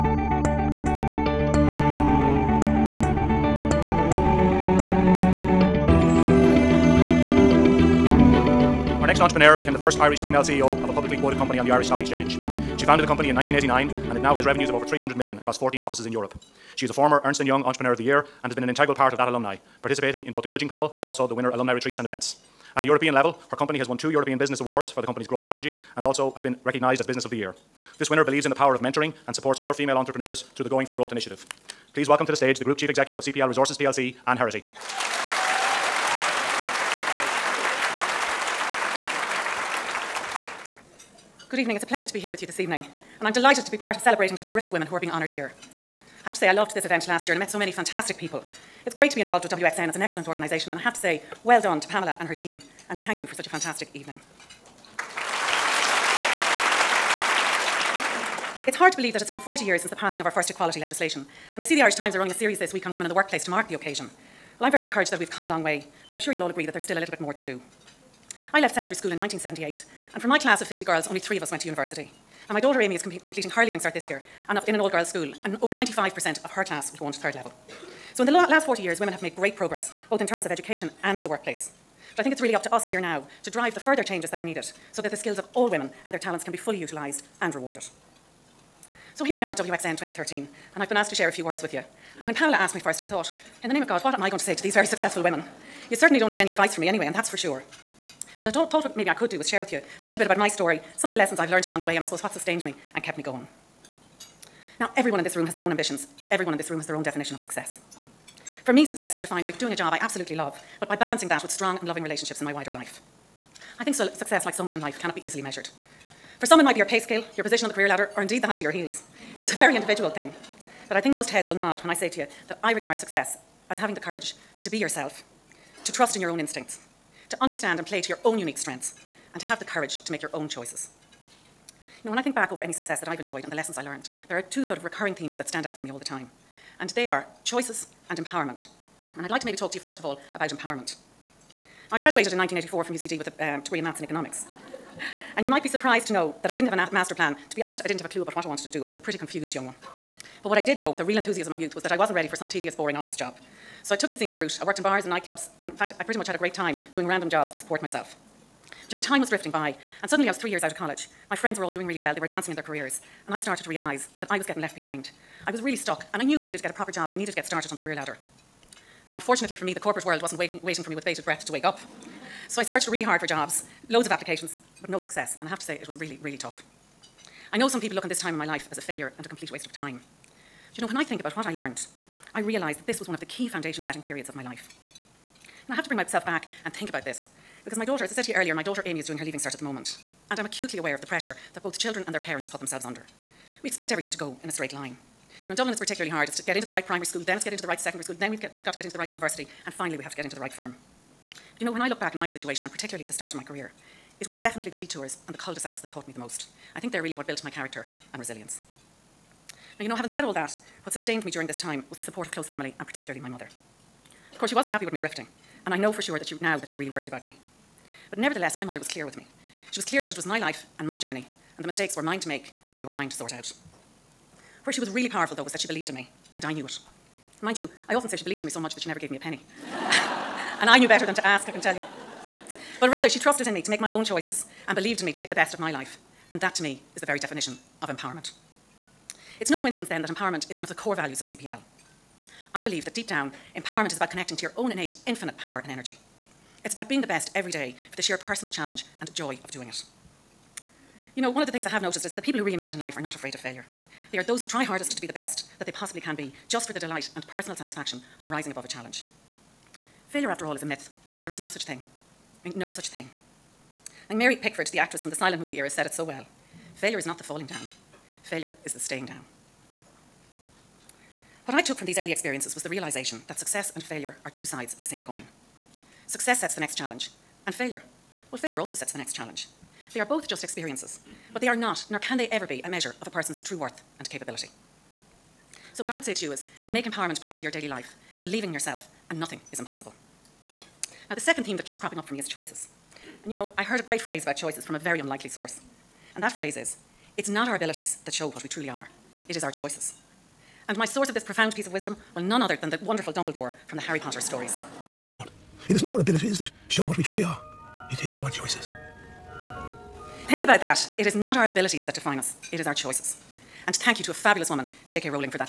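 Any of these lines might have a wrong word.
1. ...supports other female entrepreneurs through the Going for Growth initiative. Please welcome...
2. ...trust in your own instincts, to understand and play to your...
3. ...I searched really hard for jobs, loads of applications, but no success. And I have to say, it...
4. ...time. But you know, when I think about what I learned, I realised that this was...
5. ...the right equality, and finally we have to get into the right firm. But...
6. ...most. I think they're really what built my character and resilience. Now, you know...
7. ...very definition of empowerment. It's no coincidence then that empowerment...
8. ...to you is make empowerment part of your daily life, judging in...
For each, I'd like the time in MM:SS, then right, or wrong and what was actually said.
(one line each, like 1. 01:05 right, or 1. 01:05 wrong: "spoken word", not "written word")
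1. 00:29 right
2. 02:05 right
3. 02:52 right
4. 02:59 right
5. 03:18 wrong: "university", not "equality"
6. 03:26 right
7. 03:57 right
8. 04:46 wrong: "believing", not "judging".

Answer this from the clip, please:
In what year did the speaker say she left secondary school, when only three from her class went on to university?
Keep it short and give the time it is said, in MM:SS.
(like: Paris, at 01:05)
1978, at 01:09.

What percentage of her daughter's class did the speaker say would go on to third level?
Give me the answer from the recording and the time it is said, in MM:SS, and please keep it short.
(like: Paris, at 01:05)
over 95%, at 01:15.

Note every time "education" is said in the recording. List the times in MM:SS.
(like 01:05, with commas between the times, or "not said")
01:20.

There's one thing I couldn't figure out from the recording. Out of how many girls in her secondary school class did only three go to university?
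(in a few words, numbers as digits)
50.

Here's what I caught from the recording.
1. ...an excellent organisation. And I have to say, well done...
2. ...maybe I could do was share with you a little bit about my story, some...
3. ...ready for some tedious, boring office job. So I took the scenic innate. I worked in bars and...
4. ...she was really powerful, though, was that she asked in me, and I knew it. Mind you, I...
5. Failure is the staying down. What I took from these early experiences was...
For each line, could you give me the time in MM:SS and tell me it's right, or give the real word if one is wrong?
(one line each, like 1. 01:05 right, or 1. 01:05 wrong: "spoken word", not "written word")
1. 00:49 right
2. 01:38 right
3. 02:32 wrong: "route", not "innate"
4. 03:44 wrong: "believed", not "asked"
5. 04:28 right.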